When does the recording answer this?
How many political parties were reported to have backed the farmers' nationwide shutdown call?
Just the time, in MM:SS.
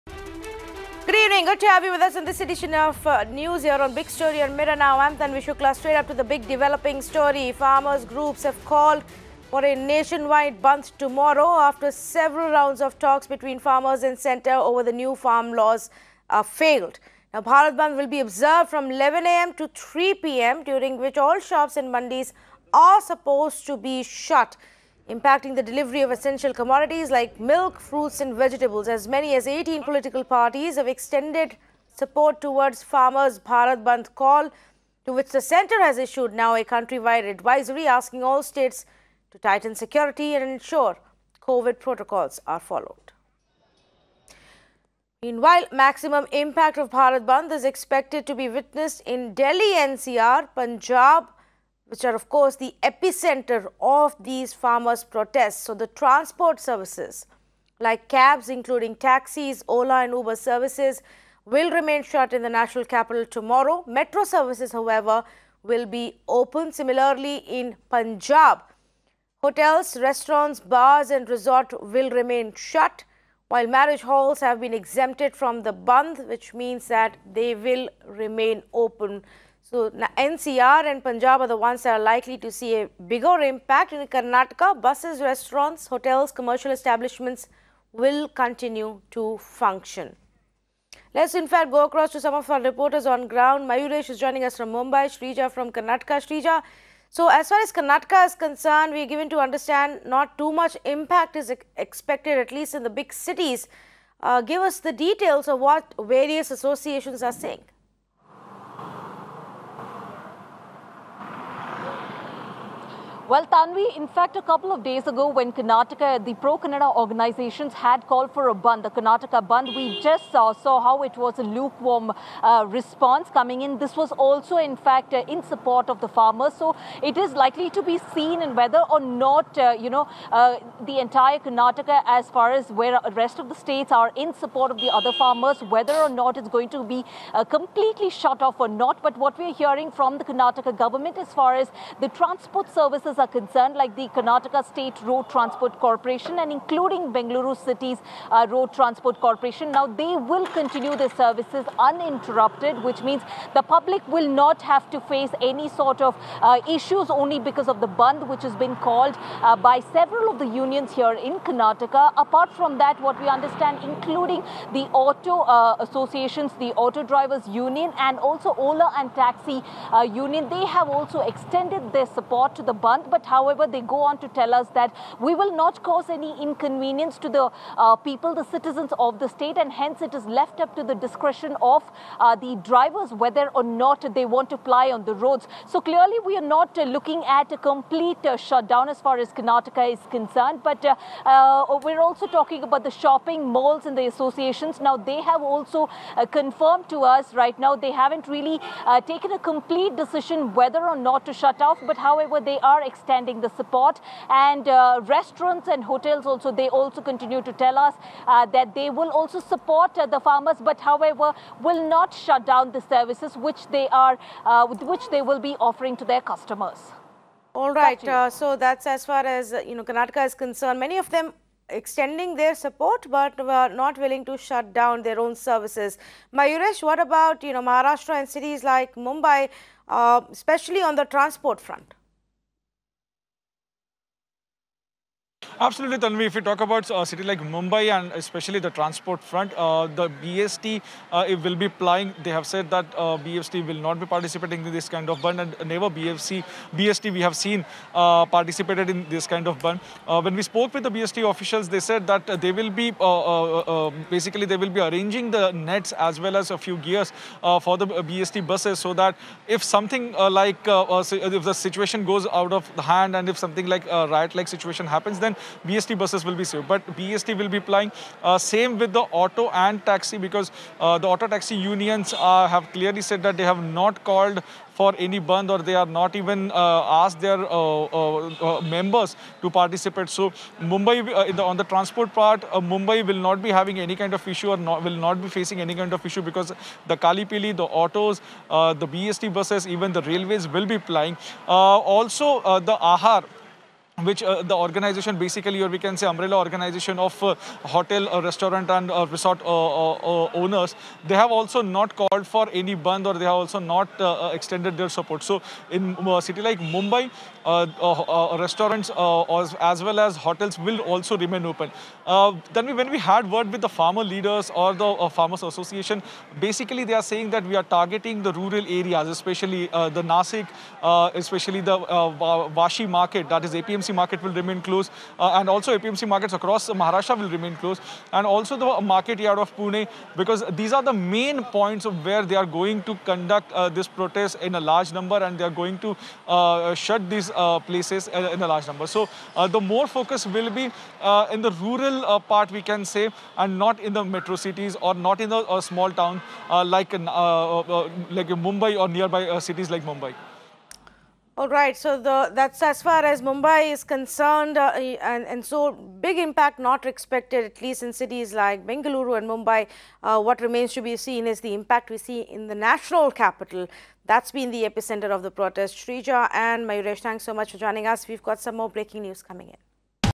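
00:29.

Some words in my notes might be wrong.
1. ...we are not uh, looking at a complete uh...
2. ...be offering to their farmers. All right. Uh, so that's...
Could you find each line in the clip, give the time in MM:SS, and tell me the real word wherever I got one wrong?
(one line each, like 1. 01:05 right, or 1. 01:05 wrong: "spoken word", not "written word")
1. 03:06 right
2. 03:35 wrong: "customers", not "farmers".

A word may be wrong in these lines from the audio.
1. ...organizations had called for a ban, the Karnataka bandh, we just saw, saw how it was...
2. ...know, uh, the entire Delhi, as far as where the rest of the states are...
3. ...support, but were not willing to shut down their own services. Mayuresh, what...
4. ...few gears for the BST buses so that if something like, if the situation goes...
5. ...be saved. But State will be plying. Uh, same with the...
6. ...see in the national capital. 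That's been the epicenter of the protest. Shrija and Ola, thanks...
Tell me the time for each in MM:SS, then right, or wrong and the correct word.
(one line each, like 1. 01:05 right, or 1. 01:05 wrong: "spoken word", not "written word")
1. 01:56 right
2. 02:09 wrong: "Karnataka", not "Delhi"
3. 03:42 right
4. 04:16 right
5. 04:26 wrong: "BST", not "State"
6. 06:01 wrong: "Mayuresh", not "Ola".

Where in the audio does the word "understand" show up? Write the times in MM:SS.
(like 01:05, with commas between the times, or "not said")
01:39, 02:43.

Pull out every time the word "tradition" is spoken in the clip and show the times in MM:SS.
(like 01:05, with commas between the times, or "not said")
not said.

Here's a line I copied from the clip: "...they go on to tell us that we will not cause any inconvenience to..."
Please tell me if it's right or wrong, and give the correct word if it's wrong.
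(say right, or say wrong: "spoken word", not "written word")
right.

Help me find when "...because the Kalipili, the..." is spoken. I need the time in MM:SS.
04:46.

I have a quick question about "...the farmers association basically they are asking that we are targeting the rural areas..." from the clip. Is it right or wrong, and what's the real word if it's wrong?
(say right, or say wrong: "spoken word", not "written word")
wrong: "saying", not "asking".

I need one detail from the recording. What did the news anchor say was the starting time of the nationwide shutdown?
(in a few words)
11 a.m.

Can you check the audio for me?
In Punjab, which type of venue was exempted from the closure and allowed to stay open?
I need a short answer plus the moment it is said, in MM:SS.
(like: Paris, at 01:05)
Marriage halls, at 01:13.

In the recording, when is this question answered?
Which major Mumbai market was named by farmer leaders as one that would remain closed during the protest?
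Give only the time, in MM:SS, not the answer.
05:22.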